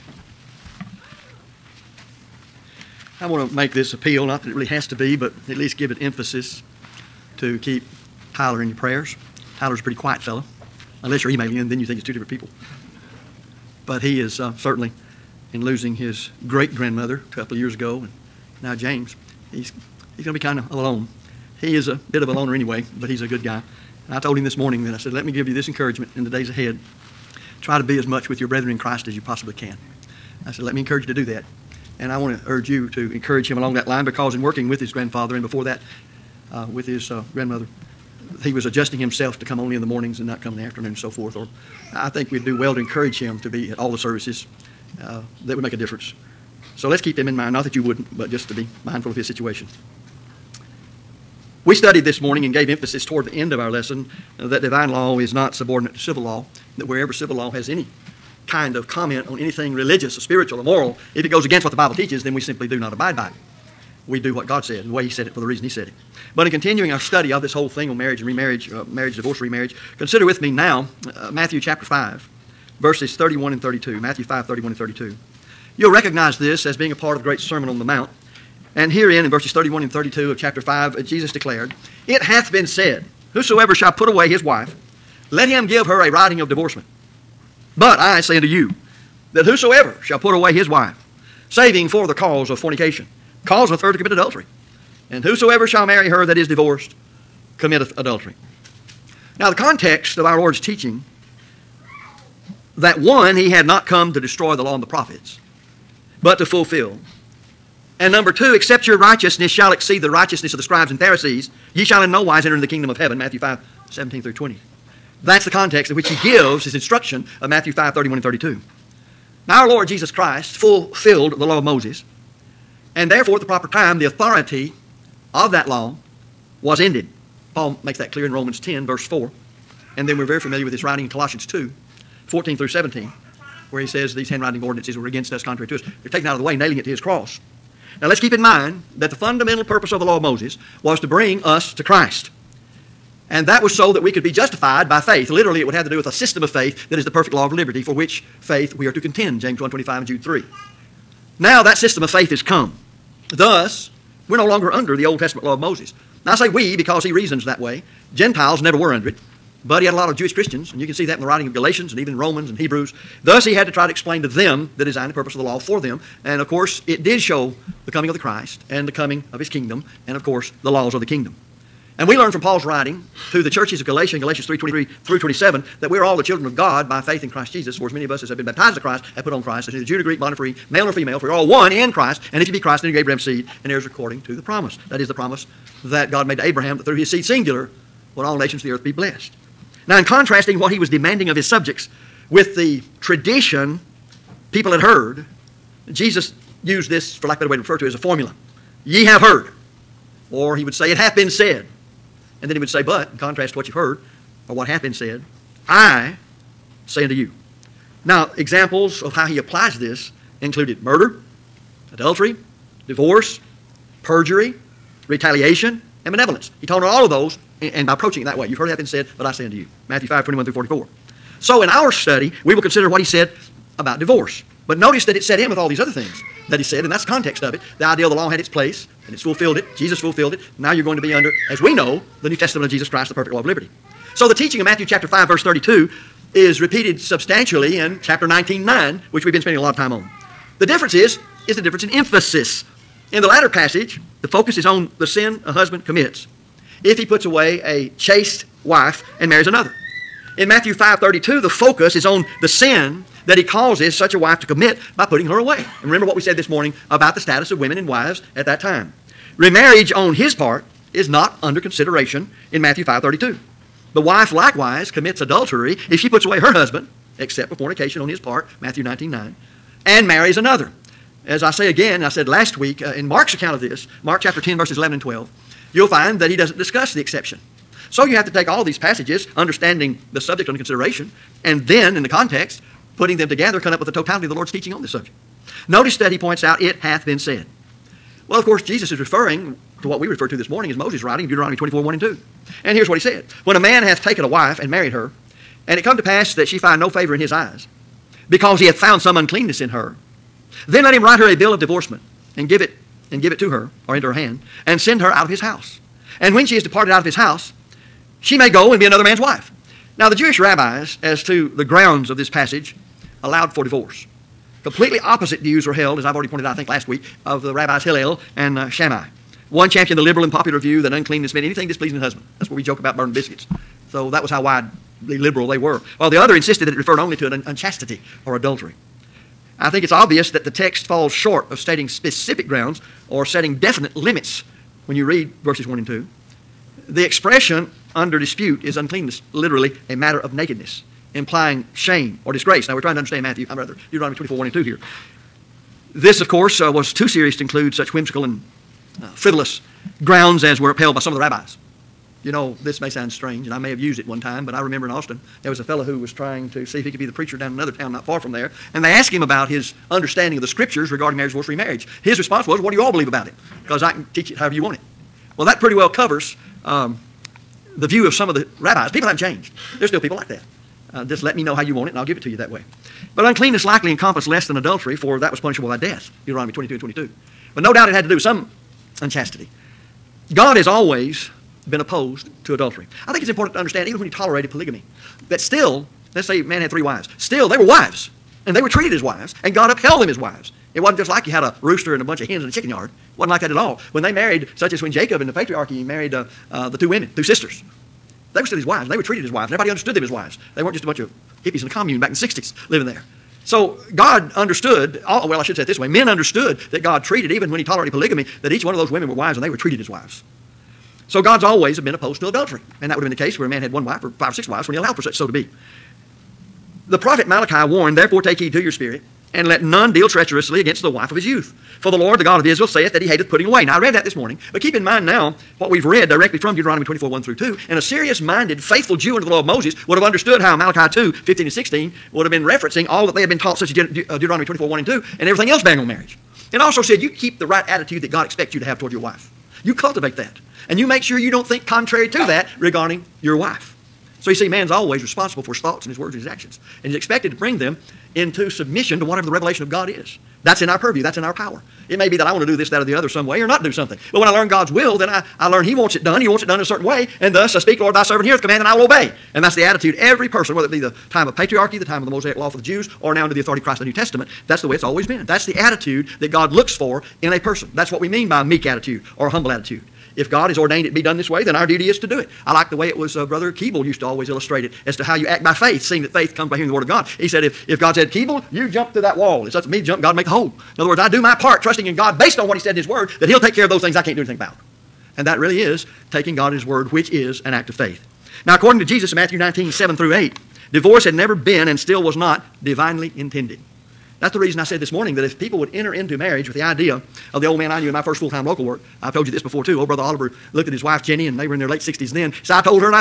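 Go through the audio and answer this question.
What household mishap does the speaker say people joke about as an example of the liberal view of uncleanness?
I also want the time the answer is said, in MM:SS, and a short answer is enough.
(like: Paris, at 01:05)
burning the biscuits, at 05:22.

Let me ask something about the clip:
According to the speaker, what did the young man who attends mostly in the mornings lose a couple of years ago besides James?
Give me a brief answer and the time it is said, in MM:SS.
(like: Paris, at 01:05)
great grandmother, at 00:16.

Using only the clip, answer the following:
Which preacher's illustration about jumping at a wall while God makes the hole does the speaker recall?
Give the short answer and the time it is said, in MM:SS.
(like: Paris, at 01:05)
Brother Keeble, at 07:53.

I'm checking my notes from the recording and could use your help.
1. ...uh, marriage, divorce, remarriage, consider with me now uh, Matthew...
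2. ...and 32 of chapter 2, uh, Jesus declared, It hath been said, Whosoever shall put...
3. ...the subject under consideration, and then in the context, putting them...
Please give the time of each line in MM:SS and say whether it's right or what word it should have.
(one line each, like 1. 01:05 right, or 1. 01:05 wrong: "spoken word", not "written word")
1. 01:08 right
2. 01:19 wrong: "5", not "2"
3. 04:40 right.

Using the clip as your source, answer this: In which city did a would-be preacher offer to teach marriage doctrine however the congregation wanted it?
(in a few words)
Austin.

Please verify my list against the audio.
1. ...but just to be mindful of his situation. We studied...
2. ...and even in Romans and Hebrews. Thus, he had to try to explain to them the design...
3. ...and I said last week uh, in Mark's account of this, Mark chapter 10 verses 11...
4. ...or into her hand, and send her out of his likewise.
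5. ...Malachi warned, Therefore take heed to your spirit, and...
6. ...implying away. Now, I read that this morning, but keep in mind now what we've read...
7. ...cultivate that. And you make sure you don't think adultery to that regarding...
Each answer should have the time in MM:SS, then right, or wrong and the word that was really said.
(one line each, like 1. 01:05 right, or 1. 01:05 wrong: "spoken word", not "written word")
1. 00:48 right
2. 02:41 right
3. 04:31 right
4. 05:03 wrong: "house", not "likewise"
5. 06:57 right
6. 07:03 wrong: "putting", not "implying"
7. 07:19 wrong: "contrary", not "adultery".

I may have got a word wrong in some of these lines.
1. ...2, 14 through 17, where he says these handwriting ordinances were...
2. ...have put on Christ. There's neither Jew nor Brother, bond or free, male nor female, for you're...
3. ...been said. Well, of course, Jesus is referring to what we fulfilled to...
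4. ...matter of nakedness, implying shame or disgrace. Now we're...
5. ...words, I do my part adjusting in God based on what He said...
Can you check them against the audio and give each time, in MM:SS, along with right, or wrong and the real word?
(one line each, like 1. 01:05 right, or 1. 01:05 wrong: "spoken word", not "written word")
1. 02:11 right
2. 02:59 wrong: "Greek", not "Brother"
3. 04:47 wrong: "referred", not "fulfilled"
4. 05:39 right
5. 08:00 wrong: "trusting", not "adjusting".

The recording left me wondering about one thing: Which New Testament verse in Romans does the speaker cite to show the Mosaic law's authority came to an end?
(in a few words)
Romans 10:4.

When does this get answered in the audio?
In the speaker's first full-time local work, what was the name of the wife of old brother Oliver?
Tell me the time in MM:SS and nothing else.
08:21.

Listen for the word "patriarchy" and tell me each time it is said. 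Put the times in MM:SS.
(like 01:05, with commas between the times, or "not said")
06:35, 07:41.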